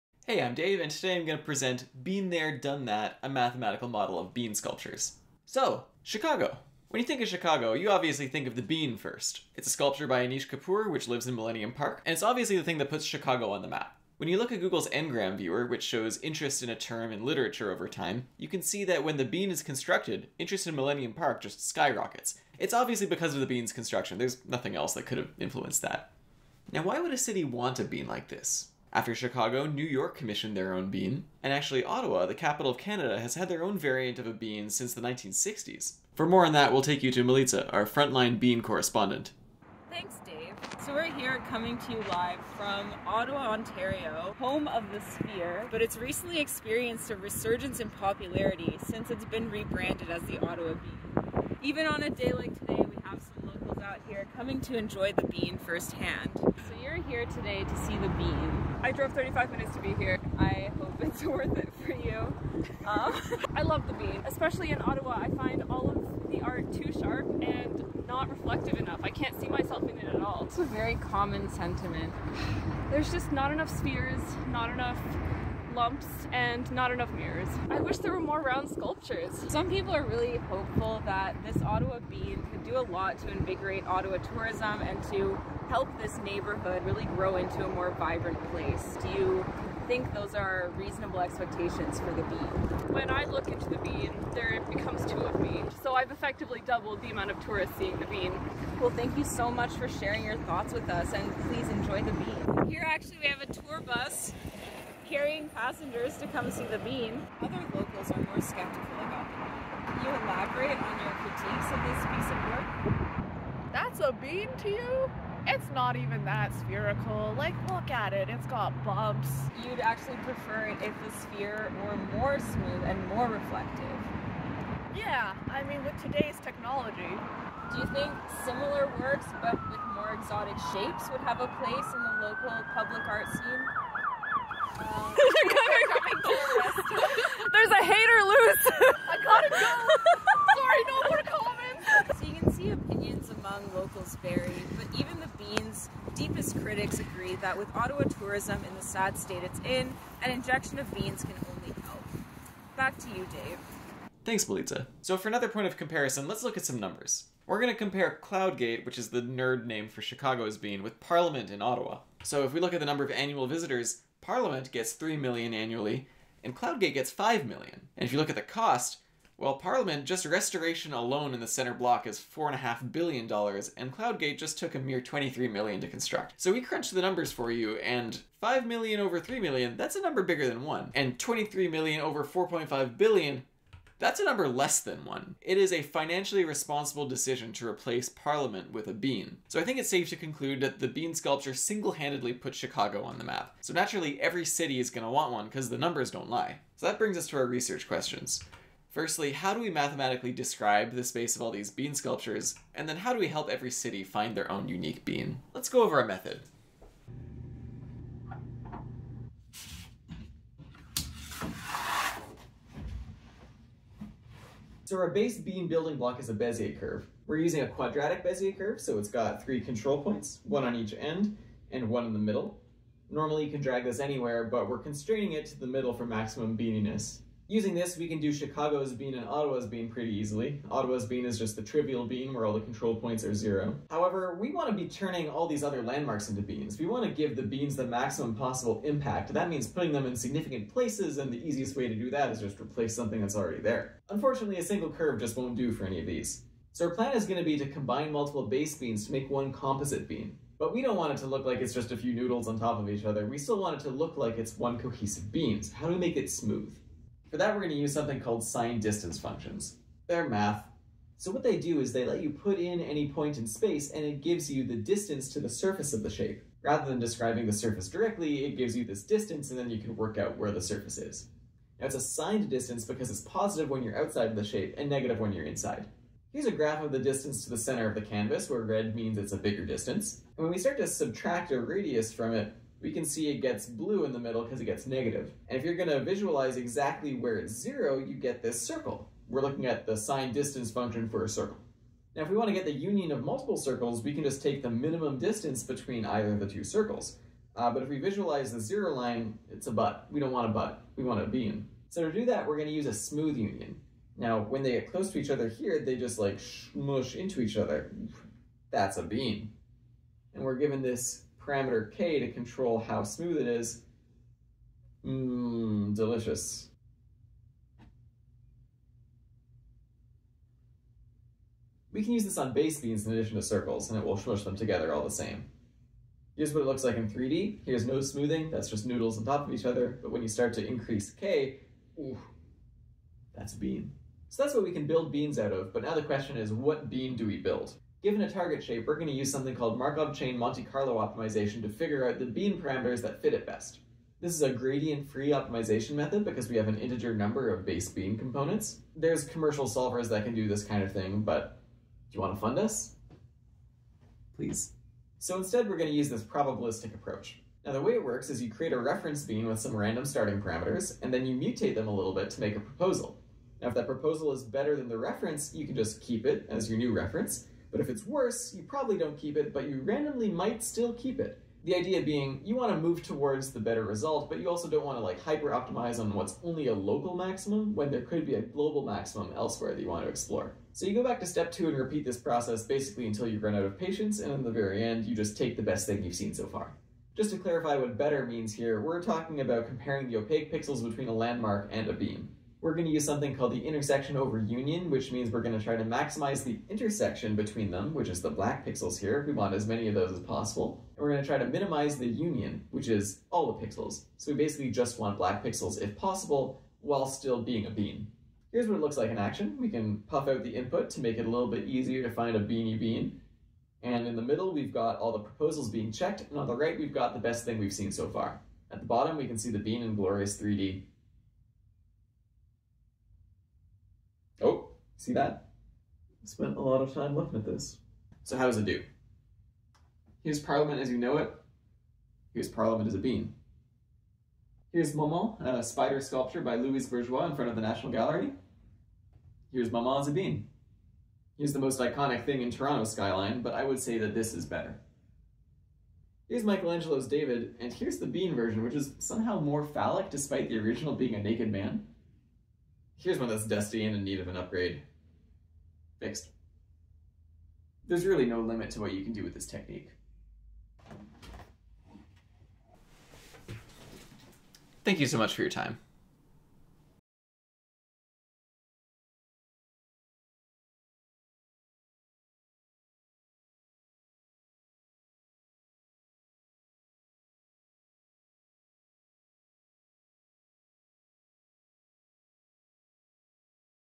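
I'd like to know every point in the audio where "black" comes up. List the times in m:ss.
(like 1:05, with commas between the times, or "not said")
6:38, 6:45.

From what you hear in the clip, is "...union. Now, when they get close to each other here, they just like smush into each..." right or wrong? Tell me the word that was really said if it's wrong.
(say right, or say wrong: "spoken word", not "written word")
right.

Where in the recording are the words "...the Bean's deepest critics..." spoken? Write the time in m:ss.
2:25.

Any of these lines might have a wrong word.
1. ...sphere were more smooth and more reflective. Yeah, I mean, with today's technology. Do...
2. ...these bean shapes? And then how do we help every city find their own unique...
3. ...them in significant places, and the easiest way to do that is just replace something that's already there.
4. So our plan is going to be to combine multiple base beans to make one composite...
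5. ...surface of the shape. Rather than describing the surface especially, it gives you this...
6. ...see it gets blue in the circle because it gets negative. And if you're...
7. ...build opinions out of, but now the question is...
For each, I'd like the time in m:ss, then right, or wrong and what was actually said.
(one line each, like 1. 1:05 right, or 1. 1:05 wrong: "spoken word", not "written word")
1. 2:01 right
2. 3:21 wrong: "sculptures", not "shapes"
3. 3:59 right
4. 4:06 right
5. 4:25 wrong: "directly", not "especially"
6. 4:43 wrong: "middle", not "circle"
7. 5:34 wrong: "beans", not "opinions".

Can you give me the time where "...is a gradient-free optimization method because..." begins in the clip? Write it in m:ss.
5:44.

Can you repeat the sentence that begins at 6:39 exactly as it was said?
We want as many of those as possible.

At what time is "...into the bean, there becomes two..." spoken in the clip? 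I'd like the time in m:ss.
1:33.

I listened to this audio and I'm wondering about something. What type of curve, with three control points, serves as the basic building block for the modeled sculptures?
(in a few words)
Quadratic Bezier curve.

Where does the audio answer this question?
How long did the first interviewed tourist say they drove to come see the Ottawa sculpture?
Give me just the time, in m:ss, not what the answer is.
0:59.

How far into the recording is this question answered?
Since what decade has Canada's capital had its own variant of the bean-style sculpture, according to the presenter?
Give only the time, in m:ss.
0:34.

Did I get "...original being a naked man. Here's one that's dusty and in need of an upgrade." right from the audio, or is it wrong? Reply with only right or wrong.
right.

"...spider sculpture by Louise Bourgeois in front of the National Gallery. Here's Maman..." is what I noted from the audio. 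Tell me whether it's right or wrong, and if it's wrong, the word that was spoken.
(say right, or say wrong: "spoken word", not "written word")
right.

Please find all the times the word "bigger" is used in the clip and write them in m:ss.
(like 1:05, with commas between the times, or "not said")
3:00, 4:39.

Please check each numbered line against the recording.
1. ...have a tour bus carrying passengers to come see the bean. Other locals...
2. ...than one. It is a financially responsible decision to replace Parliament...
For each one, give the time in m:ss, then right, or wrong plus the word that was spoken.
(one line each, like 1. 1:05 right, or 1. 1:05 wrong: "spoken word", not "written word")
1. 1:43 right
2. 3:04 right.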